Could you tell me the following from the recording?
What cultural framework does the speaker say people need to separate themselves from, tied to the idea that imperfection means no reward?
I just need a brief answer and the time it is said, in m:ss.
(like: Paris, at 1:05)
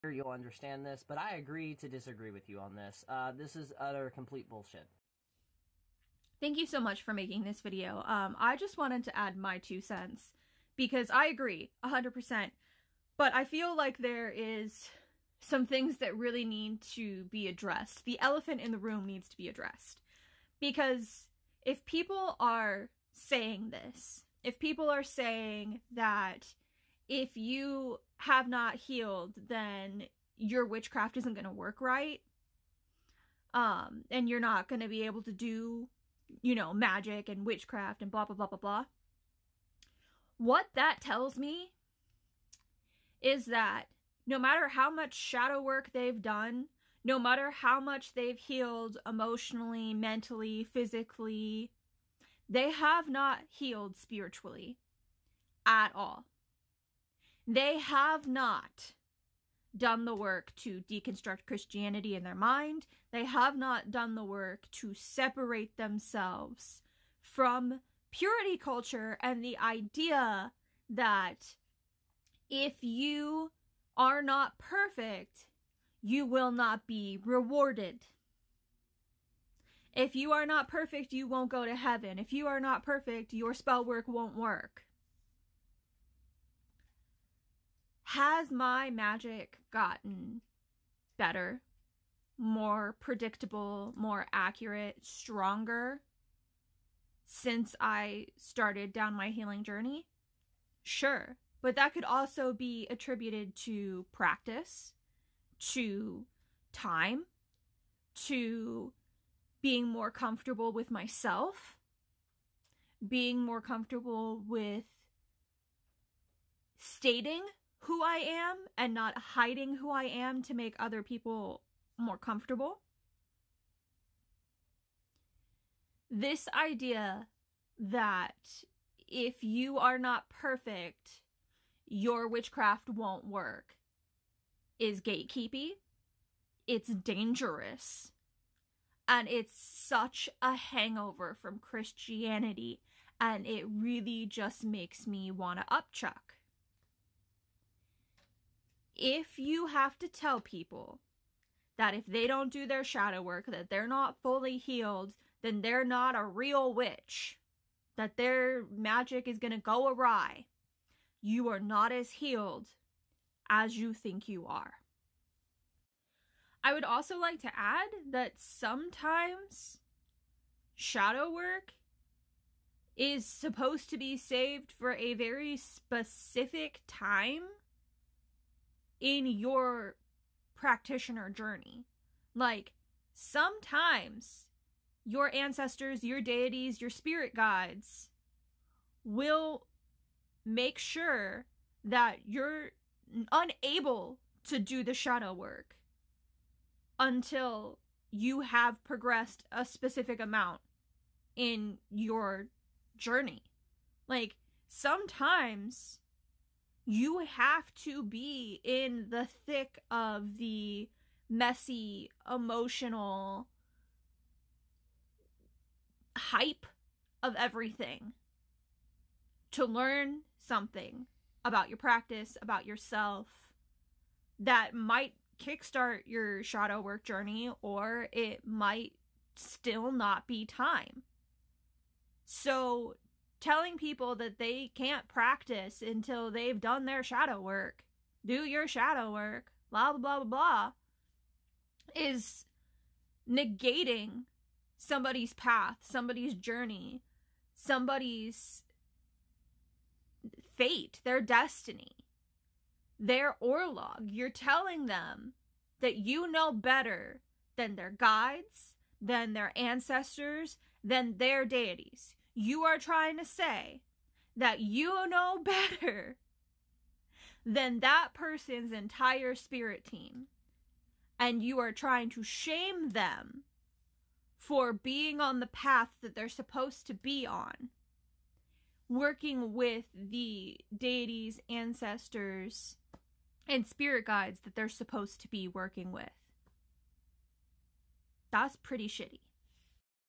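purity culture, at 1:08.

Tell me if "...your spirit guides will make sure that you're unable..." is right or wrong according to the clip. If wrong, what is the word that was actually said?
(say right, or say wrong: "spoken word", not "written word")
right.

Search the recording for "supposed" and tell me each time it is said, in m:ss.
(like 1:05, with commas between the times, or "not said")
2:53, 4:36, 4:44.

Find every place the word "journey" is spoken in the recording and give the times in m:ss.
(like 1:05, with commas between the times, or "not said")
1:39, 3:01, 3:22, 3:47, 4:06.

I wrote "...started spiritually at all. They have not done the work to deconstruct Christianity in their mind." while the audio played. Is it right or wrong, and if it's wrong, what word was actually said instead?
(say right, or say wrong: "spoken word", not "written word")
wrong: "healed", not "started".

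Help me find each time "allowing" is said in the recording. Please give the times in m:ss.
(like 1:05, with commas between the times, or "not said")
not said.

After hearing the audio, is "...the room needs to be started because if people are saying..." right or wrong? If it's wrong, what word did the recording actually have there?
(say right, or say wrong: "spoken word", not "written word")
wrong: "addressed", not "started".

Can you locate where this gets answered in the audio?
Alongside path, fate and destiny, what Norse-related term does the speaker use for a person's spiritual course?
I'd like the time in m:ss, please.
4:13.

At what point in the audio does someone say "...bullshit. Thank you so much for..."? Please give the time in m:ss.
0:04.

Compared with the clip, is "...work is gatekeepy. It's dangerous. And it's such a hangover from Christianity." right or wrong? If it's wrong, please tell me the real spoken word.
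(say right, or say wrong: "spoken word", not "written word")
right.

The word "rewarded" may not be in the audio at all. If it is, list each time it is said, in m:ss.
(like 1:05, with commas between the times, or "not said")
1:17.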